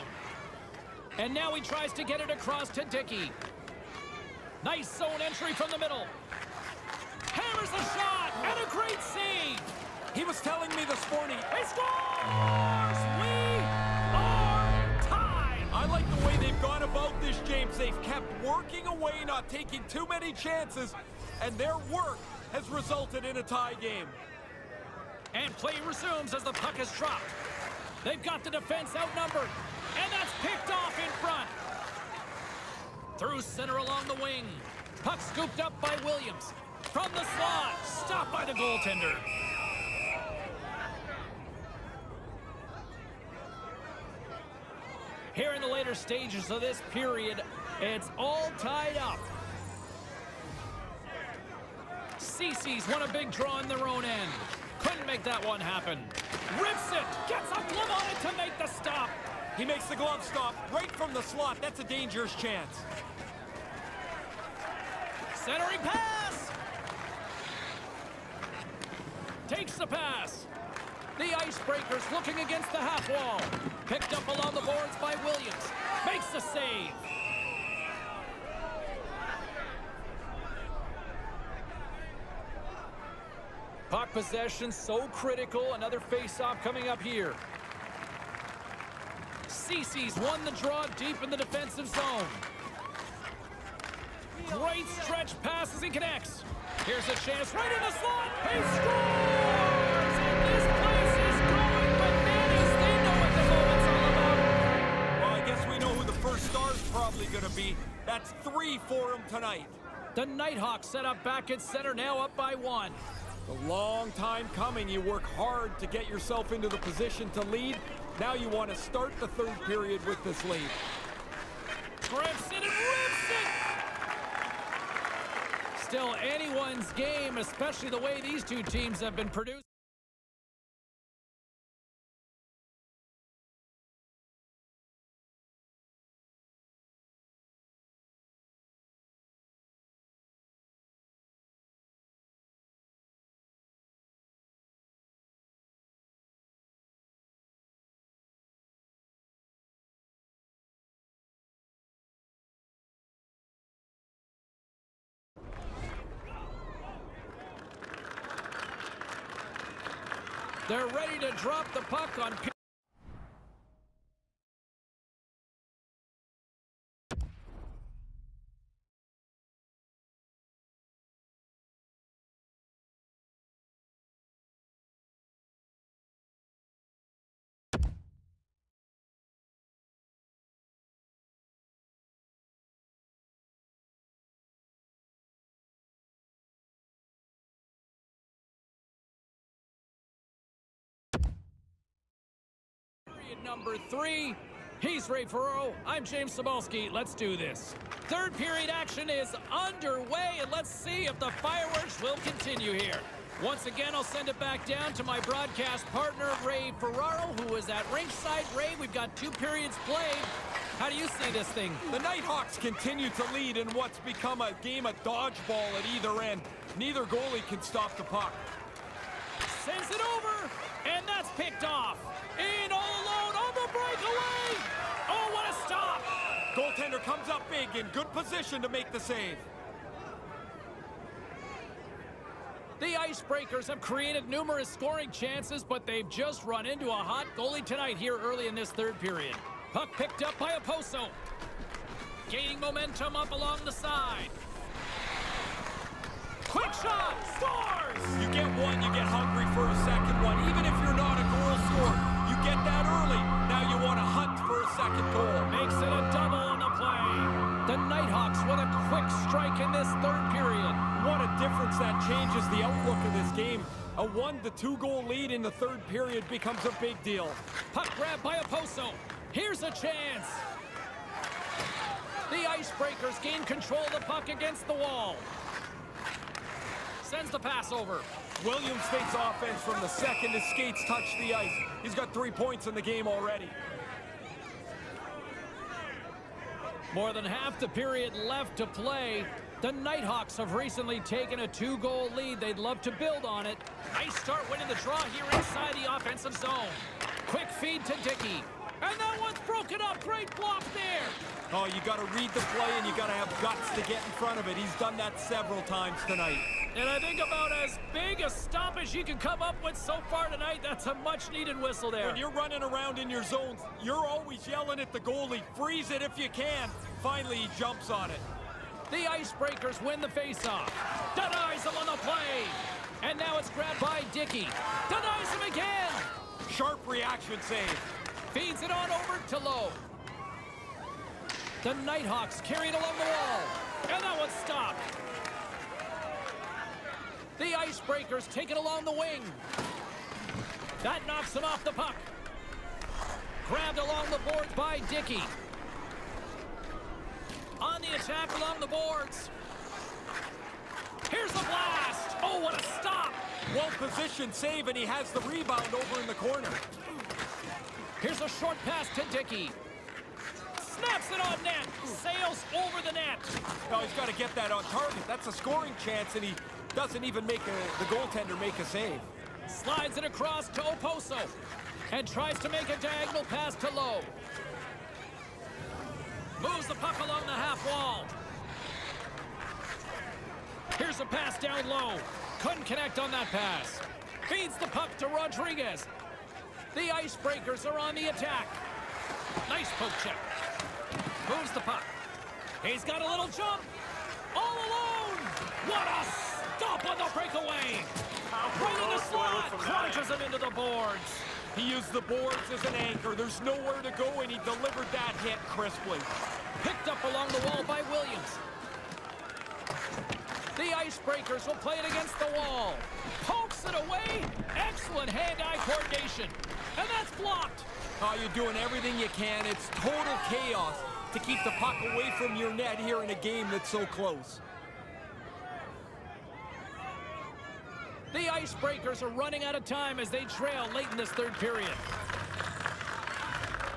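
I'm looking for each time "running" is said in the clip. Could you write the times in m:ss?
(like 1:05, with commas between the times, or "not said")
5:12, 7:09.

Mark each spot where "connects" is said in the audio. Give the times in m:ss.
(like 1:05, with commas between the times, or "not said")
1:35, 6:22.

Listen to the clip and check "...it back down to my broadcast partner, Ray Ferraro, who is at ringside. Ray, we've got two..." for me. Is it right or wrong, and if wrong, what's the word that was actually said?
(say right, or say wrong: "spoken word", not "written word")
right.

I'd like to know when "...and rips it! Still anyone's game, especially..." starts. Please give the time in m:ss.
2:02.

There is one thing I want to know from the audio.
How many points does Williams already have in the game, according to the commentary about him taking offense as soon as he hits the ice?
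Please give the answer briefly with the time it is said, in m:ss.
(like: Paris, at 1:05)
3, at 4:42.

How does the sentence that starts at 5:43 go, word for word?
Grabbed along the boards by Dickey.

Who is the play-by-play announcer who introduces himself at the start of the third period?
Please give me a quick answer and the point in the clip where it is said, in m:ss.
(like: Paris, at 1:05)
James Cybulski, at 3:16.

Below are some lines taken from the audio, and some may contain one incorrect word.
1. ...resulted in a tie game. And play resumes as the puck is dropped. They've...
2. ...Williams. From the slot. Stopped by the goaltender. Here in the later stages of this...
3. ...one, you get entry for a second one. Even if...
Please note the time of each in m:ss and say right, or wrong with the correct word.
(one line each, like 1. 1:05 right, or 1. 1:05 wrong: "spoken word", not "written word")
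1. 0:22 right
2. 0:36 right
3. 4:08 wrong: "hungry", not "entry".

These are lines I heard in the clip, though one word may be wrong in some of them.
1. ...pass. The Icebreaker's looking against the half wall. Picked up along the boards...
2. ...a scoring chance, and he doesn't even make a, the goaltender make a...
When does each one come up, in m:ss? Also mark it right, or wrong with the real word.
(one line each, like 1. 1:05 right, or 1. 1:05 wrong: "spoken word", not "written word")
1. 1:09 right
2. 6:05 right.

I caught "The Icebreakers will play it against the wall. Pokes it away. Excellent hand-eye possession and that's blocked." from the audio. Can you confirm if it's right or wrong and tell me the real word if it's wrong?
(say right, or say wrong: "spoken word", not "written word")
wrong: "coordination", not "possession".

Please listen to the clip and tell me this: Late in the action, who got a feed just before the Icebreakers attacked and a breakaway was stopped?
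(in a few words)
Rodriguez.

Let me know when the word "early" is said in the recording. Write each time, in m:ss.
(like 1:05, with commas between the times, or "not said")
3:58, 4:12.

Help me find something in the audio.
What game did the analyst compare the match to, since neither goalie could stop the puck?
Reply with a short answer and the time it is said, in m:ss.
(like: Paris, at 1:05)
dodgeball, at 3:35.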